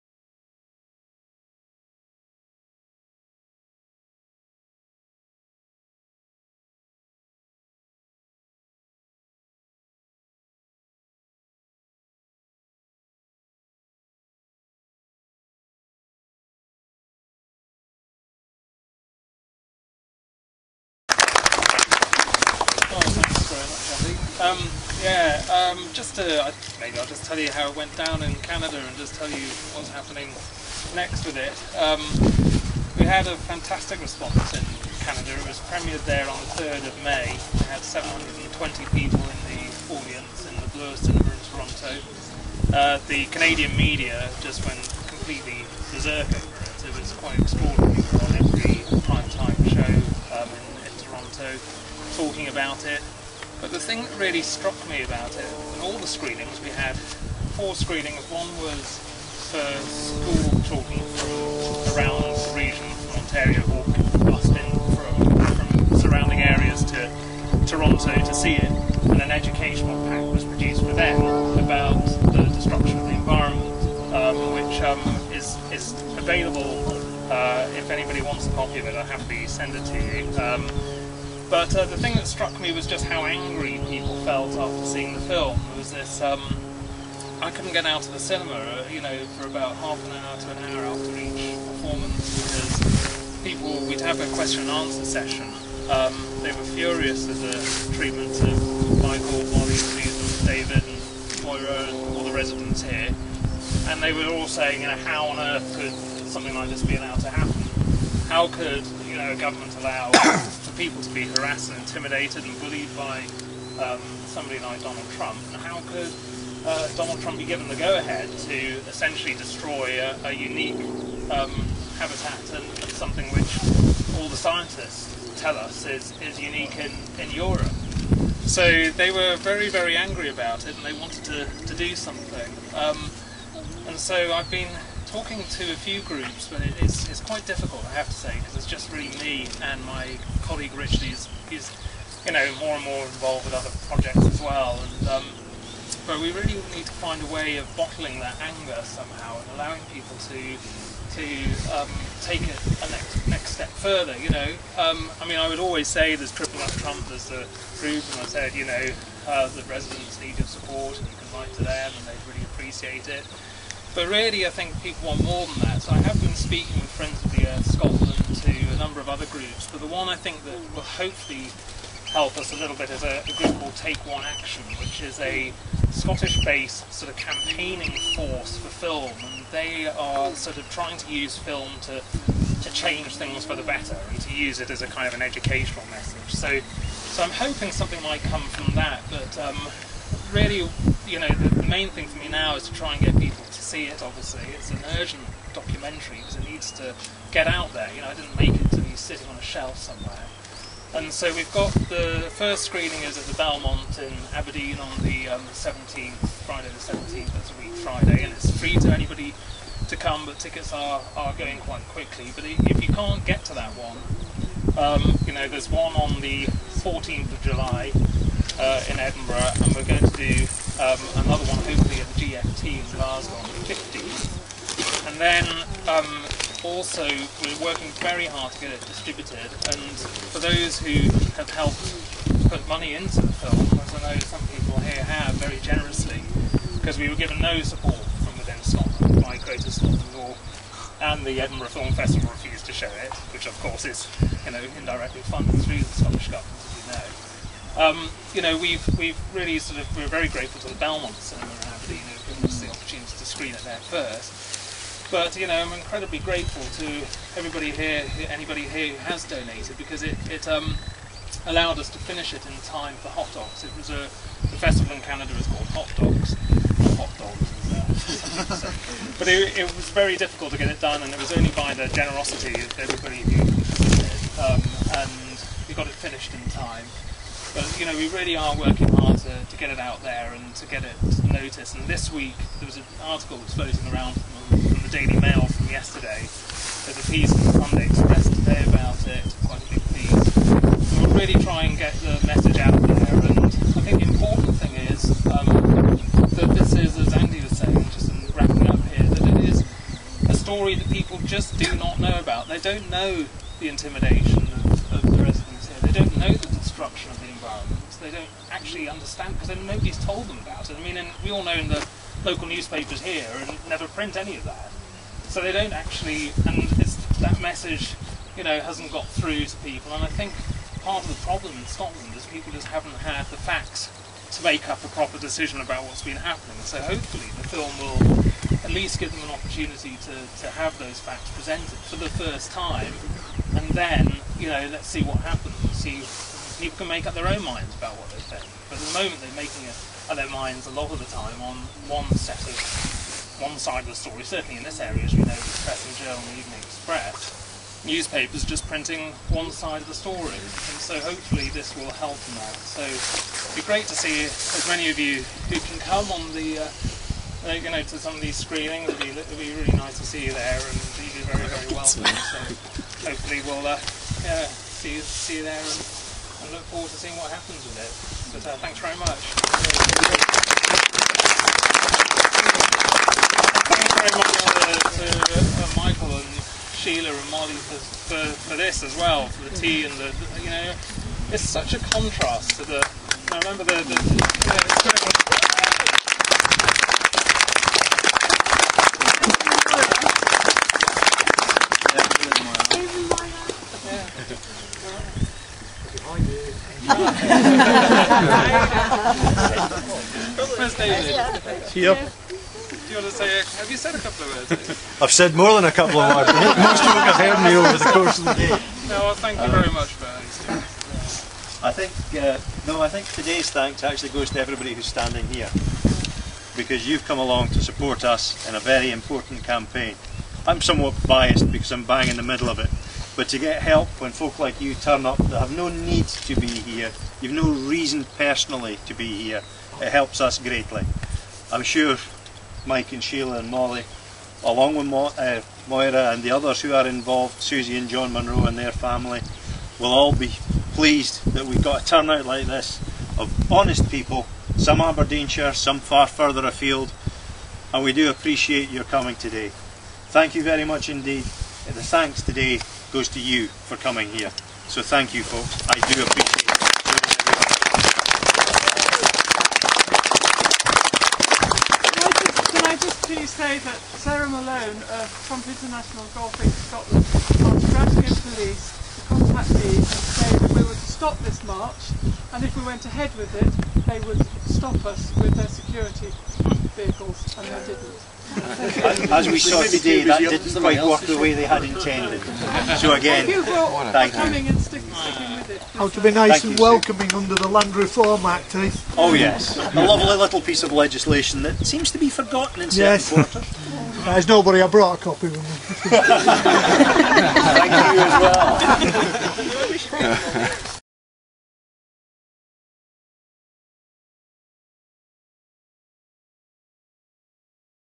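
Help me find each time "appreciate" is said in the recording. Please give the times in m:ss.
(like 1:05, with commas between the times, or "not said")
2:42, 7:28, 7:36.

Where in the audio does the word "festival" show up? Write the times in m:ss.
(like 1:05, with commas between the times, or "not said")
4:01, 4:24.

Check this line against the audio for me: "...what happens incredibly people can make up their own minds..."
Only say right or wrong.
wrong.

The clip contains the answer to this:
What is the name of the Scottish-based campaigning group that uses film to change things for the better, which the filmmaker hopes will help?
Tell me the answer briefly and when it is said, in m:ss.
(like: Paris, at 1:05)
Take One Action, at 2:53.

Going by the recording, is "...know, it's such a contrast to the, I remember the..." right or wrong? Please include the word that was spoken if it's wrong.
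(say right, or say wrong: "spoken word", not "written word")
right.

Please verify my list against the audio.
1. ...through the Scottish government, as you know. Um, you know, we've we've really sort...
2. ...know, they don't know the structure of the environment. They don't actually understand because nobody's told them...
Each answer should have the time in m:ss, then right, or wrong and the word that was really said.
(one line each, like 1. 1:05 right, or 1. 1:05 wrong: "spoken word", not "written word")
1. 4:05 right
2. 5:05 right.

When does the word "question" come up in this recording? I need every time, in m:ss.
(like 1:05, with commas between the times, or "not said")
1:34.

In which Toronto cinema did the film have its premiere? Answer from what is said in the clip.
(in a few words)
Bloor Cinema.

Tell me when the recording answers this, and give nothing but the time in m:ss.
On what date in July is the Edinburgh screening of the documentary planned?
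3:36.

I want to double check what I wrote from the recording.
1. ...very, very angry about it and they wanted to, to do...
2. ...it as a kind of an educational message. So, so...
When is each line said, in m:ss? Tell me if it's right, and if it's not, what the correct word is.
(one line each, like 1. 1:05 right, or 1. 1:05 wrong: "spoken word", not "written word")
1. 2:09 right
2. 3:04 right.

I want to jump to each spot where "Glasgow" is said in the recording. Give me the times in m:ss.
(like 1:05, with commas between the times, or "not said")
3:42, 7:47.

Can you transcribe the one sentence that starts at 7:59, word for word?
As we saw today, that didn't quite work the way they had intended.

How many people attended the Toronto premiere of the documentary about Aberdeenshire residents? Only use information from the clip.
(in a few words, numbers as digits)
720.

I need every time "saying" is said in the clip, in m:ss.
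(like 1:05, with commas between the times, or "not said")
1:44, 4:57.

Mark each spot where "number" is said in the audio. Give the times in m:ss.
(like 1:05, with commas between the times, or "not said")
2:48.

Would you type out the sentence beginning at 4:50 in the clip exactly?
we are really try and get the message out there.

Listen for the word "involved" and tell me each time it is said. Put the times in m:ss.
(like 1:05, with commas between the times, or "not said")
2:23, 7:16.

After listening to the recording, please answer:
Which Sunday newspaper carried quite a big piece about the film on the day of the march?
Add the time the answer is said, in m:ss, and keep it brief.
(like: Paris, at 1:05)
Sunday Express, at 4:47.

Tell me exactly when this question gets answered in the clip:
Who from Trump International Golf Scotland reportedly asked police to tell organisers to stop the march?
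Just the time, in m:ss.
7:43.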